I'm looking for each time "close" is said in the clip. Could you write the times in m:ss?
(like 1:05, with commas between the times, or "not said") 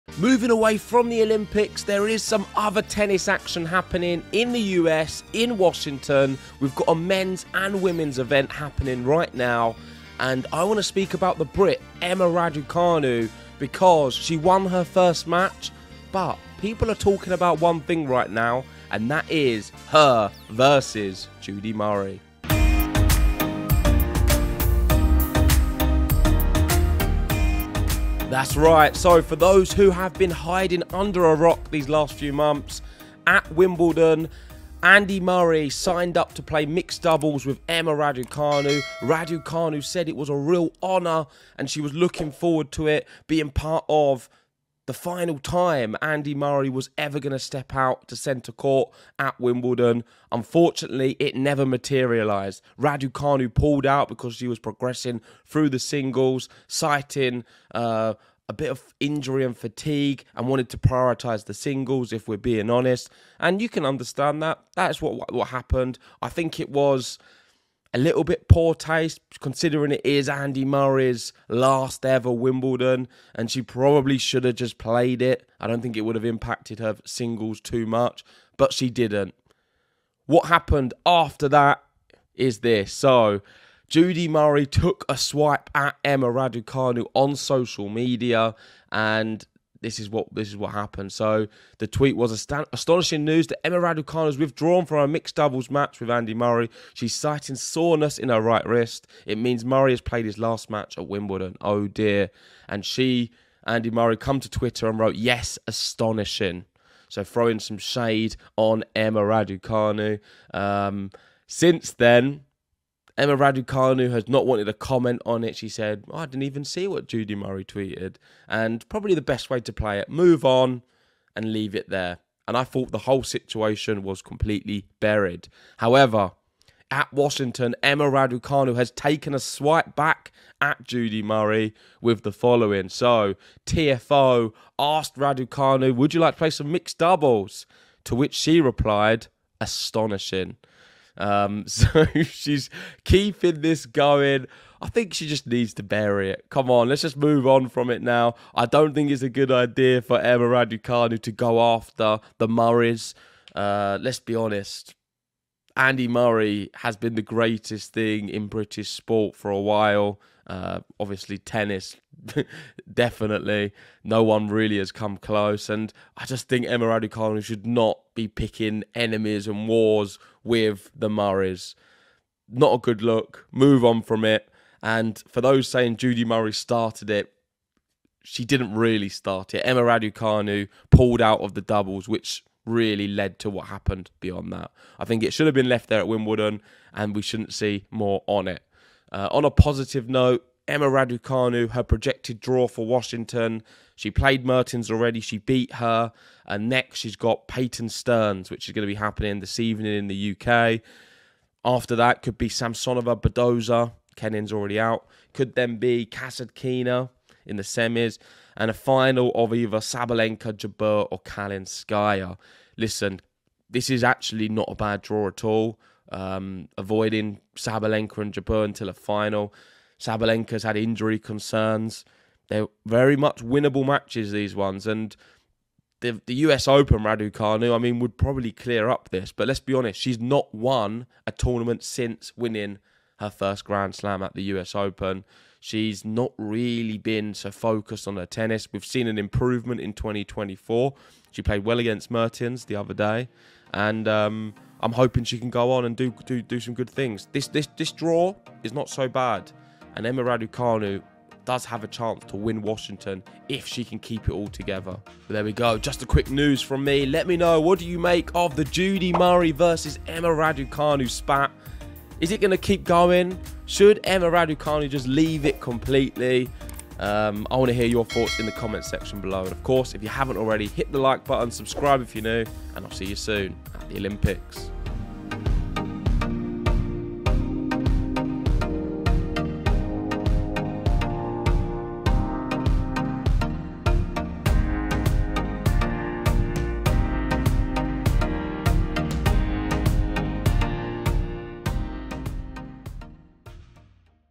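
2:45.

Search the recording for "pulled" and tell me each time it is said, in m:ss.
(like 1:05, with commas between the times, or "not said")
0:53, 3:00.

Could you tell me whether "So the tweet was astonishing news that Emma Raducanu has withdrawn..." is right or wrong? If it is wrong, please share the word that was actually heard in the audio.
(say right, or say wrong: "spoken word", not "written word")
right.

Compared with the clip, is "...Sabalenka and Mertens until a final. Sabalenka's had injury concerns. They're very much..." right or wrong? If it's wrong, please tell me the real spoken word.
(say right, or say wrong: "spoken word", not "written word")
wrong: "Jabeur", not "Mertens".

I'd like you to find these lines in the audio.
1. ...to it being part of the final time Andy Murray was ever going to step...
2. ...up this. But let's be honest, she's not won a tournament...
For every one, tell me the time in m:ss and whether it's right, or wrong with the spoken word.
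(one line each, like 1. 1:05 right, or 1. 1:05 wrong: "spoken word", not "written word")
1. 0:42 right
2. 3:48 right.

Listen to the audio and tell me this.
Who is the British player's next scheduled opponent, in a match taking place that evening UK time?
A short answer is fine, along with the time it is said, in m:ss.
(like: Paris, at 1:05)
Peyton Stearns, at 3:17.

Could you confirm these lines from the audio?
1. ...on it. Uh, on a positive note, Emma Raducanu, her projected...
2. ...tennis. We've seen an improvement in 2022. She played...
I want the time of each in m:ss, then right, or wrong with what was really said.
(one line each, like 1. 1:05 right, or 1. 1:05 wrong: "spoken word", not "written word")
1. 3:08 right
2. 3:58 wrong: "2024", not "2022".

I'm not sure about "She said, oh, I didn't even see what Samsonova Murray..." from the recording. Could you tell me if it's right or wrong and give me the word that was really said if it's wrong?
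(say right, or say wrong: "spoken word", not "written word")
wrong: "Judy", not "Samsonova".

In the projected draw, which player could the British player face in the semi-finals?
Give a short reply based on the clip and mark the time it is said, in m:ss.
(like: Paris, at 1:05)
Kasatkina, at 3:26.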